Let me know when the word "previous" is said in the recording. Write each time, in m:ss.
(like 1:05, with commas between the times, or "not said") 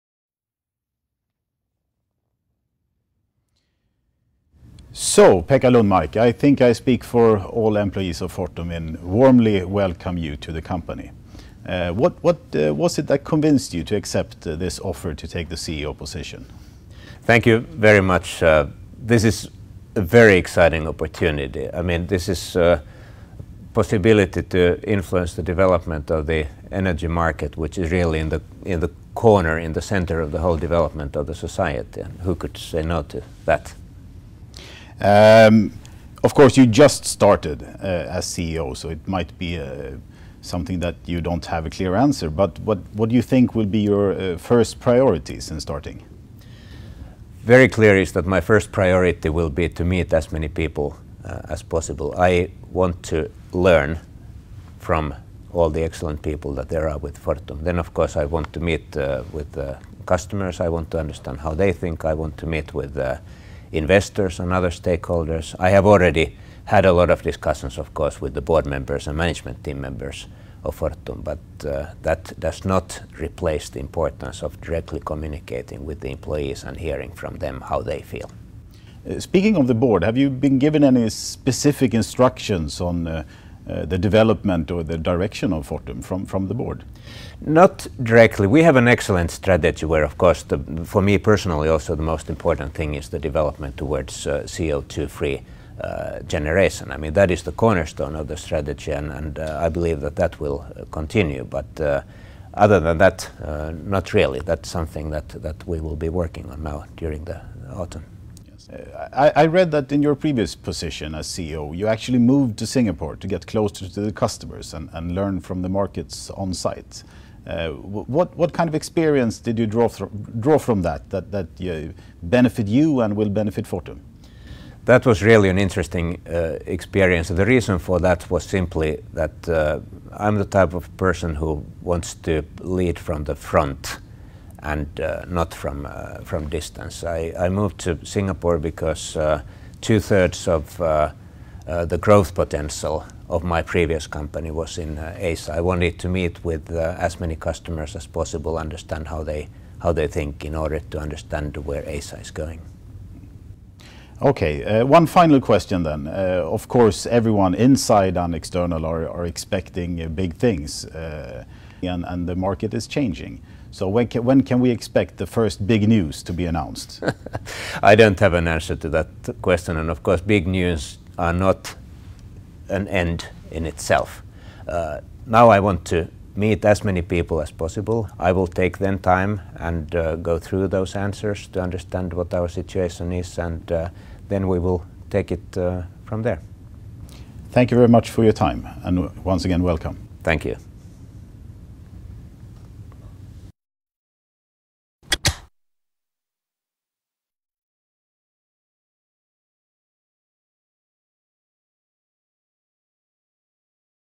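1:50, 2:23.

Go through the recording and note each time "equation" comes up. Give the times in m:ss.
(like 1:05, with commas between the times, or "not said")
not said.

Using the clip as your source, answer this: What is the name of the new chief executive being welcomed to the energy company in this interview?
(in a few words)
Pekka Lundmark.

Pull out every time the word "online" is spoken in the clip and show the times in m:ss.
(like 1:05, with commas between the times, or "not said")
not said.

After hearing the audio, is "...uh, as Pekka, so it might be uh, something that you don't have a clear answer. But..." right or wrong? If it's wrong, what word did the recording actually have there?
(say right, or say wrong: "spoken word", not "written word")
wrong: "CEO", not "Pekka".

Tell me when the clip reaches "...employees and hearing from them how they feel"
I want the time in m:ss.
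1:16.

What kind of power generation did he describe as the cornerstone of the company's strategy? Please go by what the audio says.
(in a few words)
CO2-free generation.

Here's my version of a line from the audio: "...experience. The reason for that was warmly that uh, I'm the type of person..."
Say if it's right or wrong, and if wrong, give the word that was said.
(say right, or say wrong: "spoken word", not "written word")
wrong: "simply", not "warmly".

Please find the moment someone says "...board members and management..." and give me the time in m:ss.
1:08.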